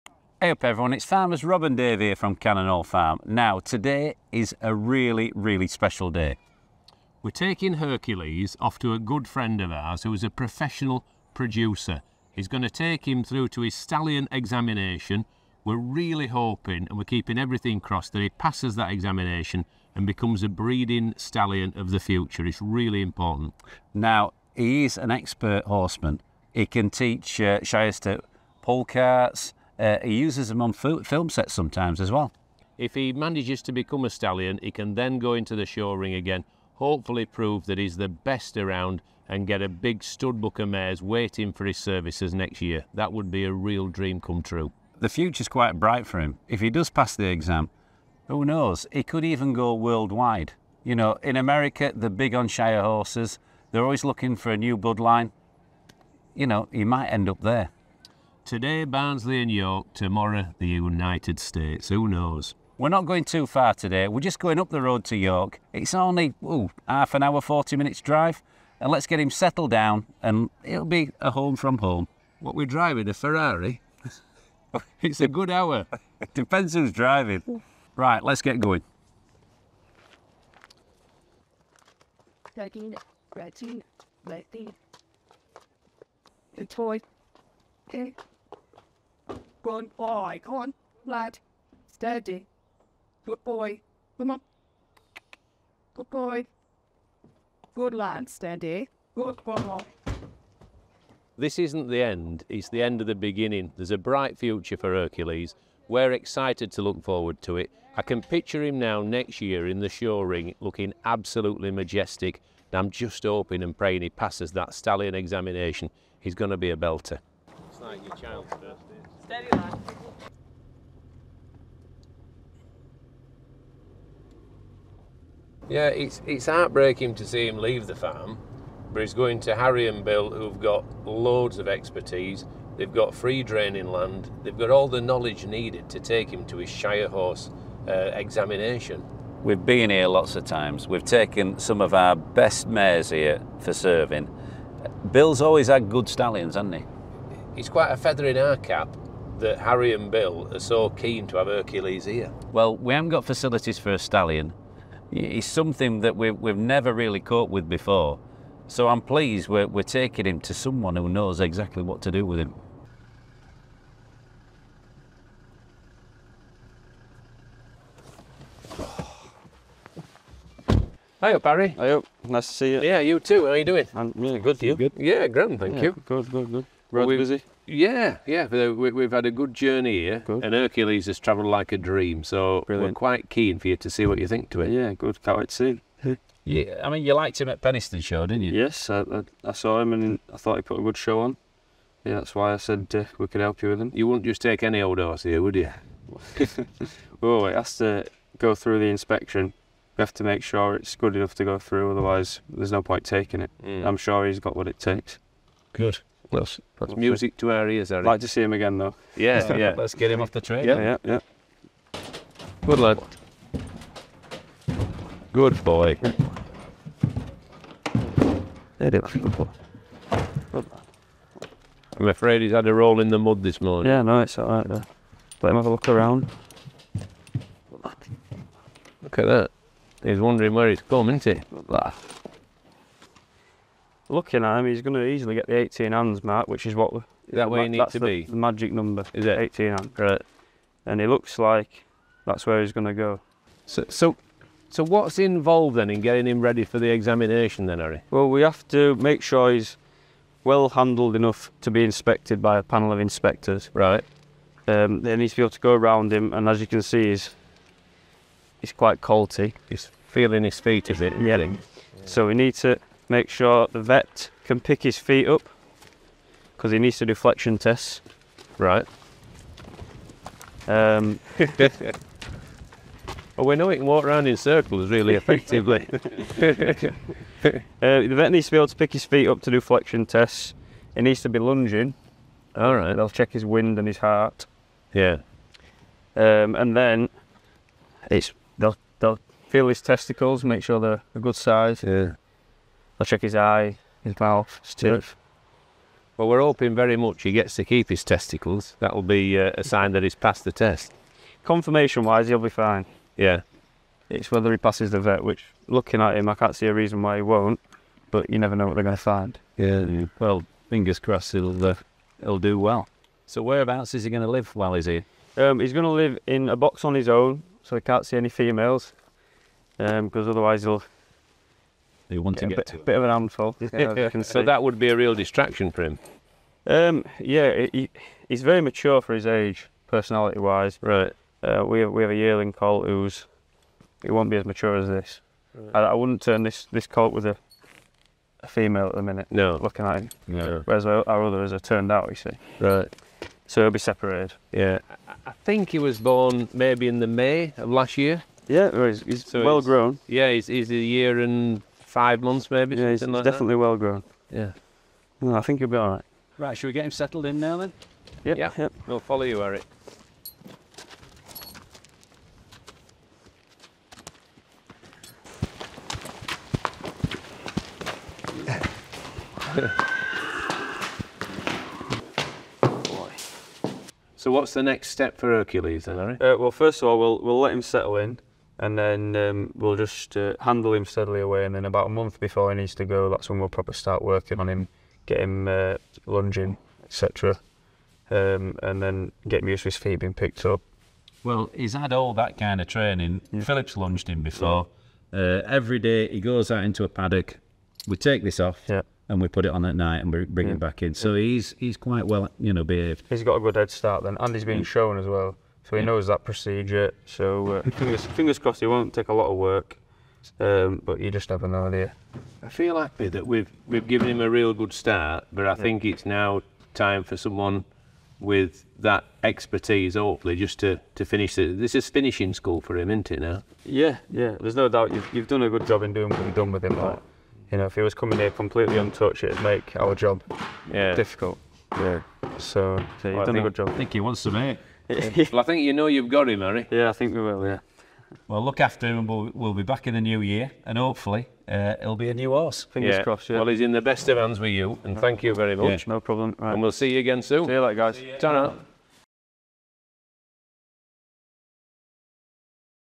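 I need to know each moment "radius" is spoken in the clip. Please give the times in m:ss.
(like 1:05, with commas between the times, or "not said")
not said.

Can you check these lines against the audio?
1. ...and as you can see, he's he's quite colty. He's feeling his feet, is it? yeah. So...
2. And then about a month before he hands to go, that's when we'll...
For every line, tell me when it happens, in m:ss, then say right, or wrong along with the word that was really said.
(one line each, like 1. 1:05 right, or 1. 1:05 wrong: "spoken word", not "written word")
1. 4:16 right
2. 6:21 wrong: "needs", not "hands".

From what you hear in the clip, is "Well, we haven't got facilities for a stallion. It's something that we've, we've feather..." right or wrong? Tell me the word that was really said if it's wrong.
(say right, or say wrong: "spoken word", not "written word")
wrong: "never", not "feather".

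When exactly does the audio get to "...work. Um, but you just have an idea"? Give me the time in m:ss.
6:49.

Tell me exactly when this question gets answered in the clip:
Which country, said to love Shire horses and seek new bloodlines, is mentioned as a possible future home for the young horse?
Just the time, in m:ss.
0:51.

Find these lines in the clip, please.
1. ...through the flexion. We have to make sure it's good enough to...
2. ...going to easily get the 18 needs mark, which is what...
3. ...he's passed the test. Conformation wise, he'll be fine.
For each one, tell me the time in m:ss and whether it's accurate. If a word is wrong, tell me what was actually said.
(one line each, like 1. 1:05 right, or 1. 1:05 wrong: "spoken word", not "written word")
1. 3:18 wrong: "inspection", not "flexion"
2. 3:54 wrong: "hands", not "needs"
3. 5:00 right.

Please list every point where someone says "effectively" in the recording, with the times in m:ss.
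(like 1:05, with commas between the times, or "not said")
4:35.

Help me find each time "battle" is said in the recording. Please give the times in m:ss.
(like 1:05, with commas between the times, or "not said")
not said.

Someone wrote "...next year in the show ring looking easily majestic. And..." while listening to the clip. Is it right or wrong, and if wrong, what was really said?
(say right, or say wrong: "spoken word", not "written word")
wrong: "absolutely", not "easily".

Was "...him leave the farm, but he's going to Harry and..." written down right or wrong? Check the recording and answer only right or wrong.
right.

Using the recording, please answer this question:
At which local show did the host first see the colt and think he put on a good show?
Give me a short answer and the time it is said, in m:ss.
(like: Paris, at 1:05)
Penistone Show, at 3:07.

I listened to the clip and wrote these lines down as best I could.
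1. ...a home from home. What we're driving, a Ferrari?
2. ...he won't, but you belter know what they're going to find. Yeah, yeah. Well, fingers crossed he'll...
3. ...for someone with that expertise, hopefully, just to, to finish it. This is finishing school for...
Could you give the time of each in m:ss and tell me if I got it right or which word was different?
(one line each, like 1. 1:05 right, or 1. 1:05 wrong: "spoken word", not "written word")
1. 1:11 right
2. 5:07 wrong: "never", not "belter"
3. 6:57 right.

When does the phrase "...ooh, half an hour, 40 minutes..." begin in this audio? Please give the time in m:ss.
1:06.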